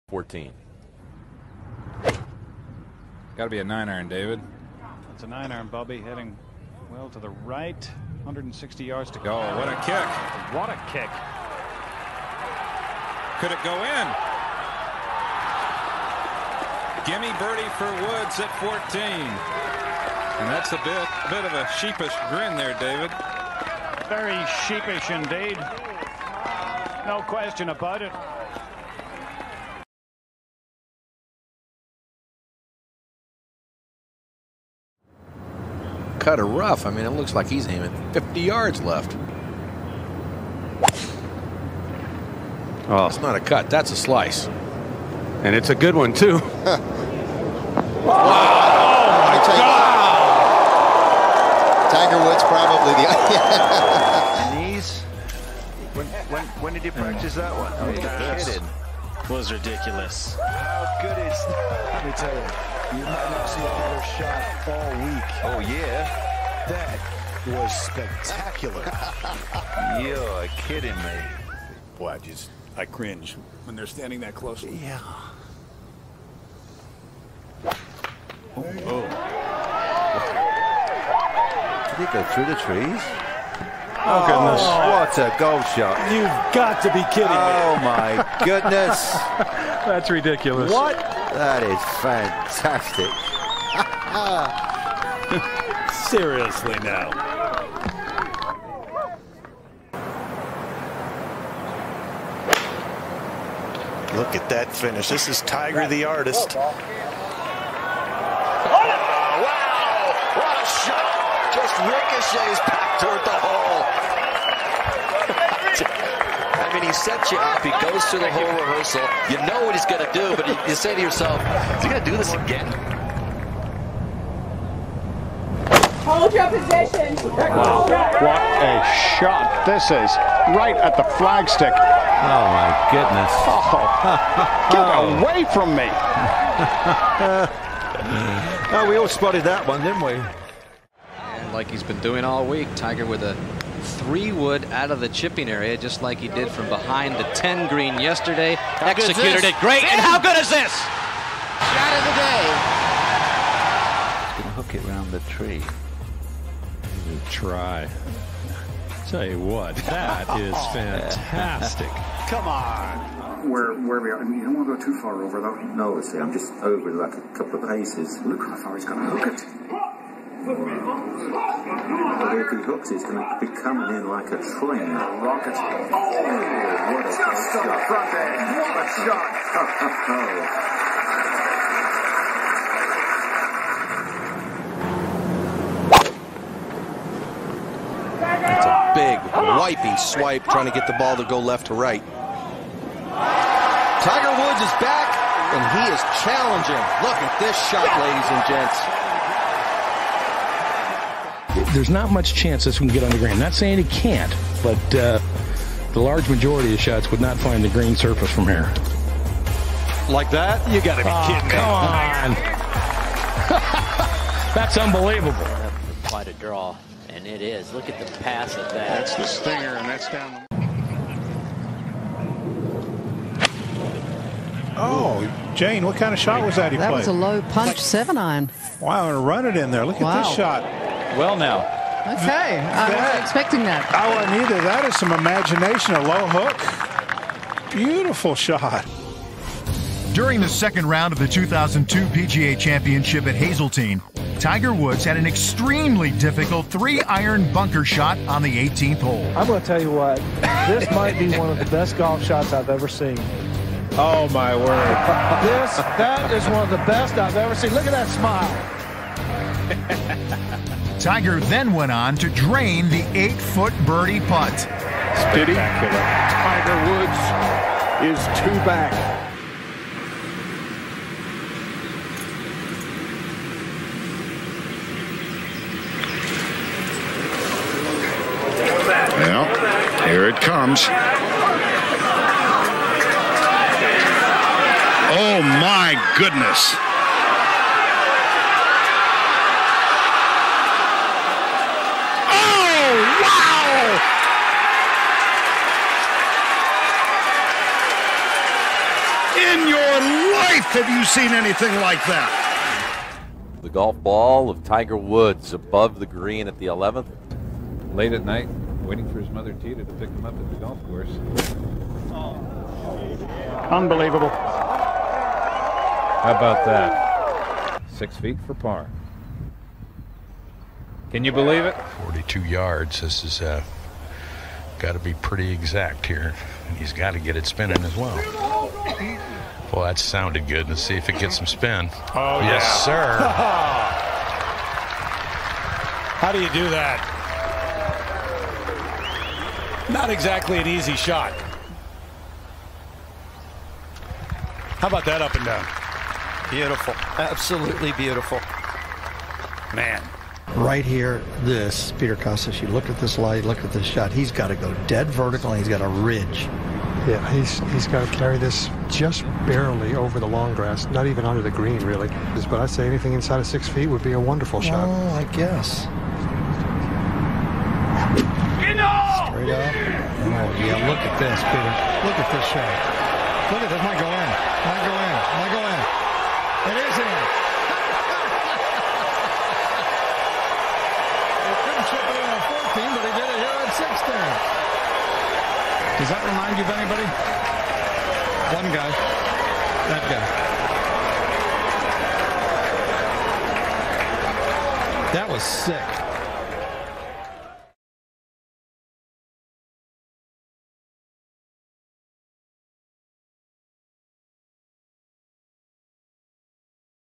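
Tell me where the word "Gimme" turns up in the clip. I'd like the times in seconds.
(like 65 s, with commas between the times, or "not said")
17 s.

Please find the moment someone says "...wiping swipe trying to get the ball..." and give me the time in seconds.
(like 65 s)
189 s.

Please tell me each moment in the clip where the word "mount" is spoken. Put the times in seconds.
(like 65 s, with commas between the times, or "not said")
not said.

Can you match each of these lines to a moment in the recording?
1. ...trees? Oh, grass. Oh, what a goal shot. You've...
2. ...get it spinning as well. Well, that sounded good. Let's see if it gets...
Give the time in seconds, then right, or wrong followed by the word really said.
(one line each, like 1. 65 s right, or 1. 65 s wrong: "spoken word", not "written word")
1. 82 s wrong: "goodness", not "grass"
2. 327 s right.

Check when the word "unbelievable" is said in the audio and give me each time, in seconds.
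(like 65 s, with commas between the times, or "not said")
214 s, 313 s.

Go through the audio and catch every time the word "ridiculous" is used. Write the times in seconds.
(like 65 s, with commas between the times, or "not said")
59 s, 90 s.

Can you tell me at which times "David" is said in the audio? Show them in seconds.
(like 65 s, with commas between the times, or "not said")
4 s, 22 s.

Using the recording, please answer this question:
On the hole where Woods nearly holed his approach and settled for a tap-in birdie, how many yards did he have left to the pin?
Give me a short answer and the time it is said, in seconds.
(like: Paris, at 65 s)
160, at 8 s.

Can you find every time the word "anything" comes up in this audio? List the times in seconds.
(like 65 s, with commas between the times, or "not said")
301 s, 362 s.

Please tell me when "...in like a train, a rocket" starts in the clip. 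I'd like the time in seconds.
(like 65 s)
173 s.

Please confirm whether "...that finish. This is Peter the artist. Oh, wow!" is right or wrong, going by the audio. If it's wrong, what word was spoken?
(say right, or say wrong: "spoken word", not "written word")
wrong: "Tiger", not "Peter".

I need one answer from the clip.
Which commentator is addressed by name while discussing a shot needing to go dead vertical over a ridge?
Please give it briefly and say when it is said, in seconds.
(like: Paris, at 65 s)
Peter Kostis, at 351 s.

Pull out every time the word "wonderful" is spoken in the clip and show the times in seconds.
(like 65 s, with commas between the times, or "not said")
364 s.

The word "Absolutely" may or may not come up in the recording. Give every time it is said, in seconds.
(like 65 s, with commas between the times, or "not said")
347 s.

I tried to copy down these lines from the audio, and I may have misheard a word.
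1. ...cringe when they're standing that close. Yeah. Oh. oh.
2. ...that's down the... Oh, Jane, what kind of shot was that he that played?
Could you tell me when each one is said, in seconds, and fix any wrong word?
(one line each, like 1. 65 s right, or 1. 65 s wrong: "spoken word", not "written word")
1. 72 s right
2. 219 s right.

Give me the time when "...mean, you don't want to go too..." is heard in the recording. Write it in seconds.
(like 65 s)
164 s.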